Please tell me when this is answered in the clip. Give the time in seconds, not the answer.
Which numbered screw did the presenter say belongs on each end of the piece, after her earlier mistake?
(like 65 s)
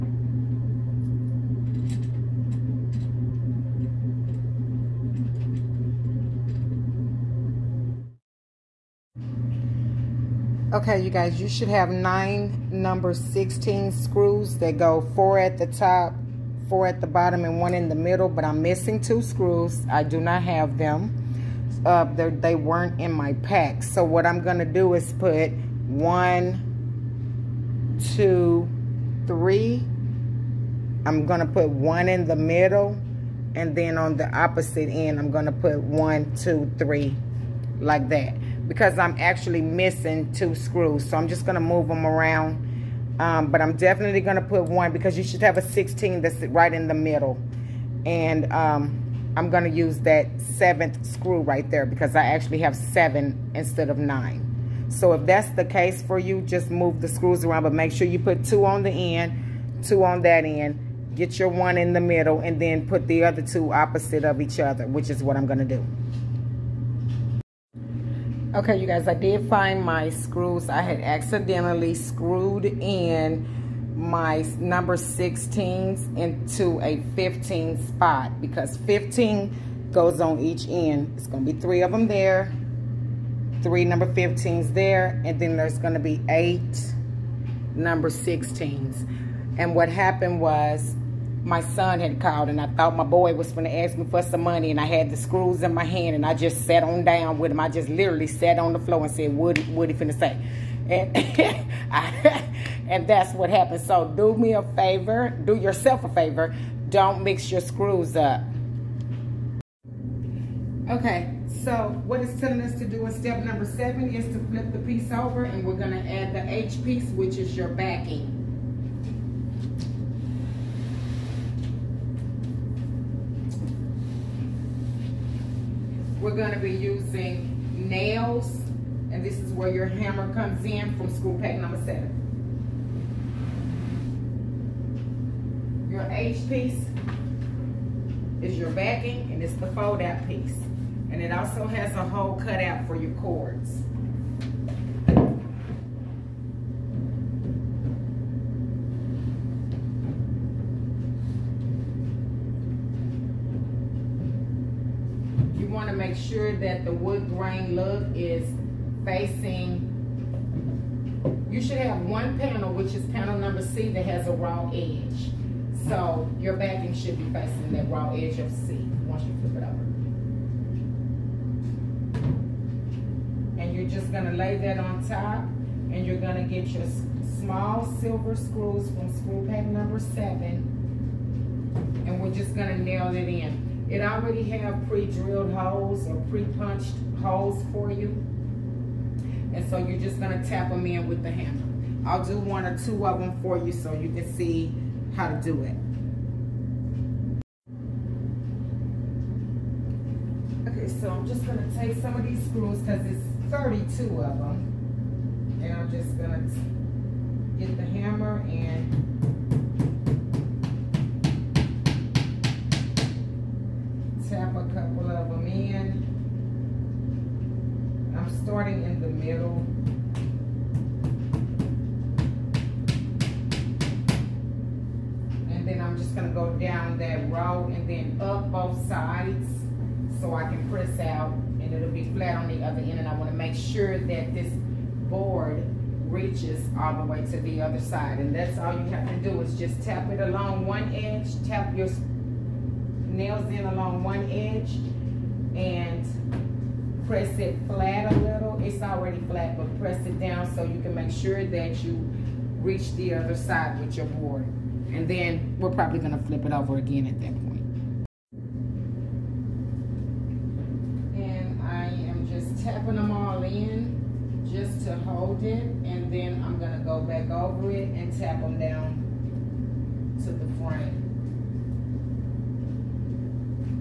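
78 s.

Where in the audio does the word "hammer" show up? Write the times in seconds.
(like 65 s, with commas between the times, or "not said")
129 s, 191 s, 207 s.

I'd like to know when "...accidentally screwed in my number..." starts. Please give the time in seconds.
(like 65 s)
71 s.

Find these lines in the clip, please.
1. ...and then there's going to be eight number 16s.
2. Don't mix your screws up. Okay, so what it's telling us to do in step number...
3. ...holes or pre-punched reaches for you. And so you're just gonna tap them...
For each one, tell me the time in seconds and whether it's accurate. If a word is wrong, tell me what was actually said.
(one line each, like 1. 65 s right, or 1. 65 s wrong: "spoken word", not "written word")
1. 85 s right
2. 106 s right
3. 185 s wrong: "holes", not "reaches".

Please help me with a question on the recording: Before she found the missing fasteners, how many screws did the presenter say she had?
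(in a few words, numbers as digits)
7.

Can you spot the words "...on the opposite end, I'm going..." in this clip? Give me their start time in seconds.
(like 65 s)
33 s.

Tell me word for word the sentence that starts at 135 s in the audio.
Your H piece is your backing, and it's the fold out piece.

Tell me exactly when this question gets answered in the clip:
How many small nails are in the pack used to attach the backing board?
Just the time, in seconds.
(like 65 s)
203 s.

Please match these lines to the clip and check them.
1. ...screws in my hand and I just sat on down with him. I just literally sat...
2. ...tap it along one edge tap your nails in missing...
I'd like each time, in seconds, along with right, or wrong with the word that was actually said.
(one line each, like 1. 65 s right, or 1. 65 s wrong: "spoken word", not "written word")
1. 95 s right
2. 239 s wrong: "along", not "missing".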